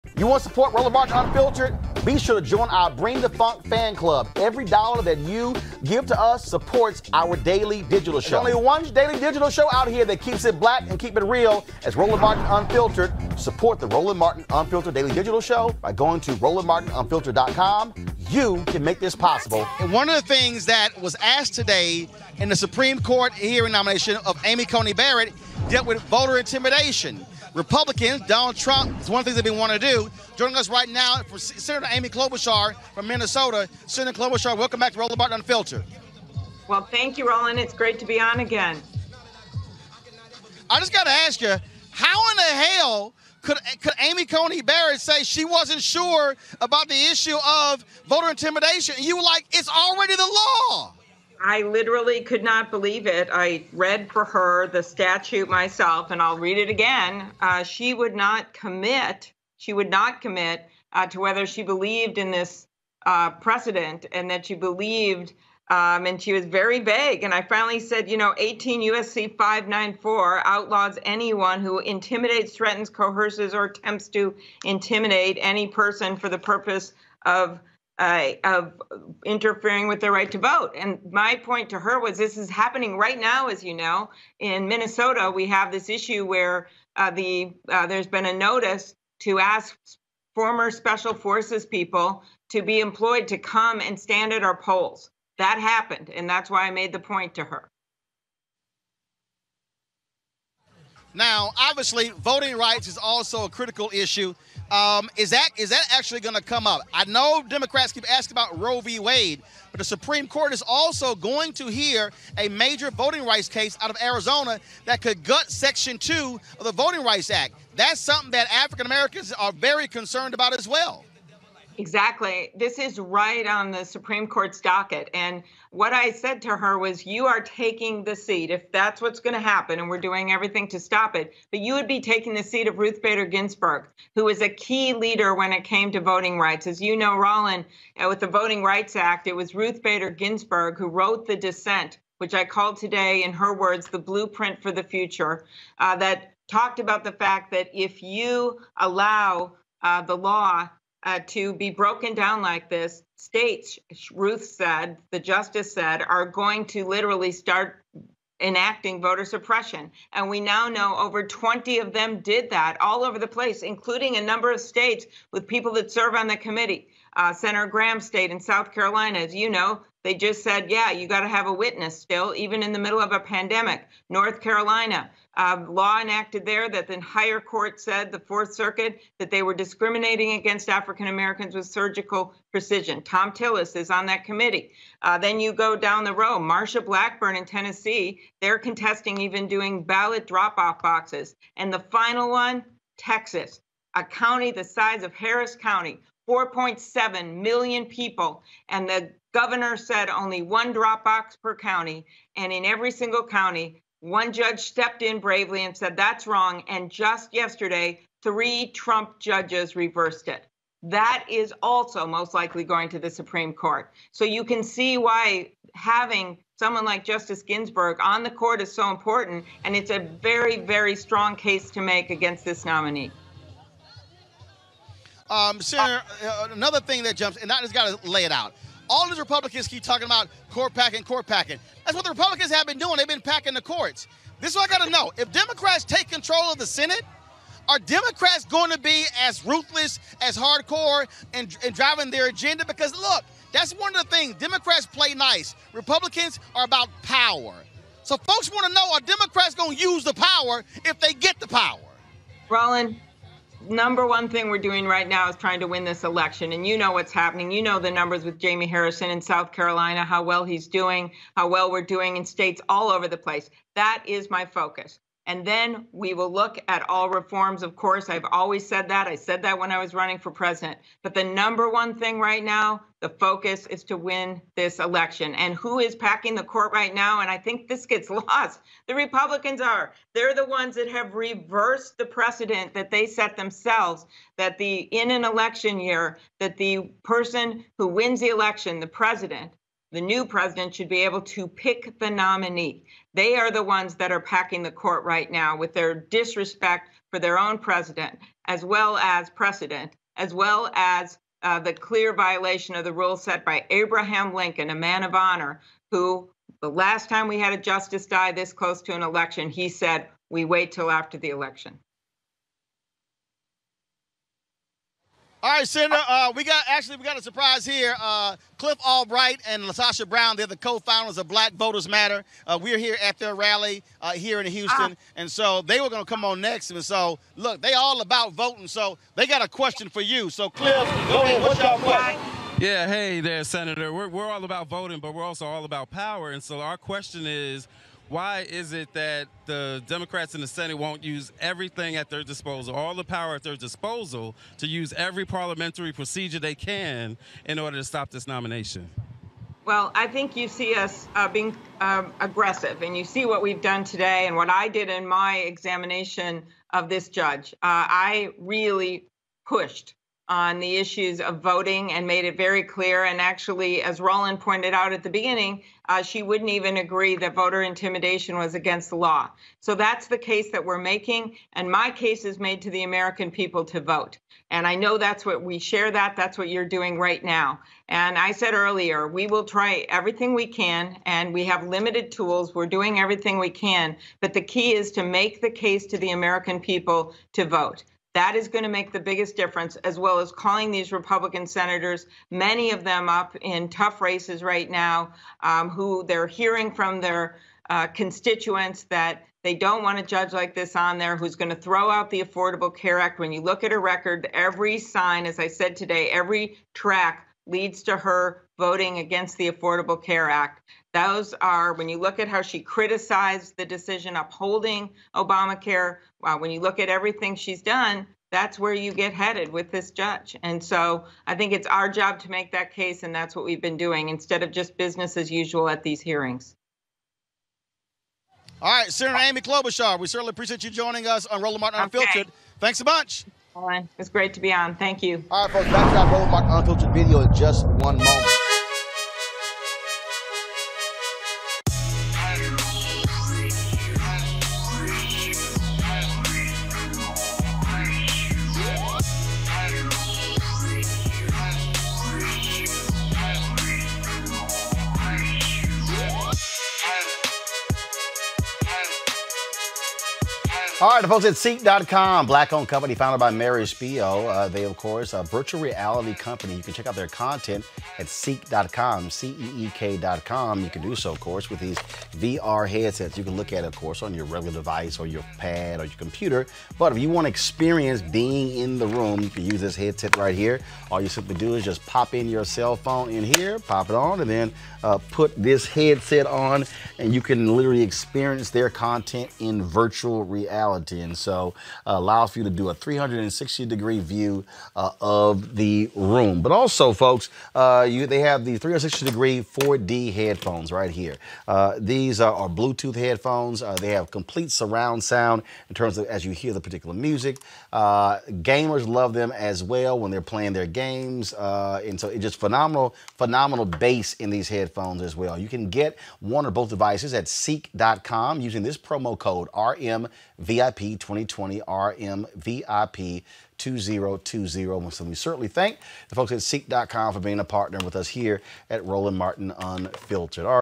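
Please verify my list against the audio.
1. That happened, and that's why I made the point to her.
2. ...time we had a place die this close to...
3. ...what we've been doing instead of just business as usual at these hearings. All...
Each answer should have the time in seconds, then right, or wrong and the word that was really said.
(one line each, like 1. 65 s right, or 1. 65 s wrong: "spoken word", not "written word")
1. 95 s right
2. 307 s wrong: "justice", not "place"
3. 423 s right.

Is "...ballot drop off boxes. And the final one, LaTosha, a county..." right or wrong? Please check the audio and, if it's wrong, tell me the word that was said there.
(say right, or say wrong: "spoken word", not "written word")
wrong: "Texas", not "LaTosha".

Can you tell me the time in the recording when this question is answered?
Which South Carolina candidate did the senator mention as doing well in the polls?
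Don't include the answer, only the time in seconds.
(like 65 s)
258 s.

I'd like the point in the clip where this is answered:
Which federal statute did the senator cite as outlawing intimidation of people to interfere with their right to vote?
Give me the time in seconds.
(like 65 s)
68 s.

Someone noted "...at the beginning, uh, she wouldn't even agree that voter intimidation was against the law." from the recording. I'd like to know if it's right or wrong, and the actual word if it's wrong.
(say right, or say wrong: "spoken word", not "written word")
right.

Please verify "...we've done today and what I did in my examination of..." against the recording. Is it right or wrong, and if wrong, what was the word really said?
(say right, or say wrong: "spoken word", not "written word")
right.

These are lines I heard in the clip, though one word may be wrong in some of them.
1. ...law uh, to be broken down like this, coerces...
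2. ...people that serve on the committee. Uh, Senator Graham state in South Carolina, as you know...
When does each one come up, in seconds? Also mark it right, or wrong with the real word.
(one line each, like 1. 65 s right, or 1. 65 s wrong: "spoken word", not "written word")
1. 150 s wrong: "states", not "coerces"
2. 165 s right.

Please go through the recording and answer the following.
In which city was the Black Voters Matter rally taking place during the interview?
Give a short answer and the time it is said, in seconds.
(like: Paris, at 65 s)
Houston, at 324 s.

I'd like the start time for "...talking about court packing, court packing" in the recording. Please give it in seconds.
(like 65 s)
229 s.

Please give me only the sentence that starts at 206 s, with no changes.
And just yesterday, three Trump judges reversed it.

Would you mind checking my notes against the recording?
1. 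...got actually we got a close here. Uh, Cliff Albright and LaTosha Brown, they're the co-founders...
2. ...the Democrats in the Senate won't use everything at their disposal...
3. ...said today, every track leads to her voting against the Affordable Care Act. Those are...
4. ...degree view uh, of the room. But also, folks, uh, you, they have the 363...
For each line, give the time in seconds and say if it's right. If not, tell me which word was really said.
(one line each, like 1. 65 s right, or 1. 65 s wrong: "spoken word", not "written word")
1. 316 s wrong: "surprise", not "close"
2. 339 s right
3. 405 s right
4. 493 s wrong: "360", not "363".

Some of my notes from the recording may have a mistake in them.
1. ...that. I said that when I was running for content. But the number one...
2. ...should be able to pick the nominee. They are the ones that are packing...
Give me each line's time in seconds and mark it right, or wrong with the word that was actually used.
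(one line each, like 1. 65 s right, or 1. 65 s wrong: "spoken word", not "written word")
1. 268 s wrong: "president", not "content"
2. 290 s right.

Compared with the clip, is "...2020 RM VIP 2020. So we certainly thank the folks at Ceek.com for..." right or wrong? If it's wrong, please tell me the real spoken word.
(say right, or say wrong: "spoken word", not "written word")
right.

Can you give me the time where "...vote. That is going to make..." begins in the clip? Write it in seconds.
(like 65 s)
387 s.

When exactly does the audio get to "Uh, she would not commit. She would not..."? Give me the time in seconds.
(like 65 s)
57 s.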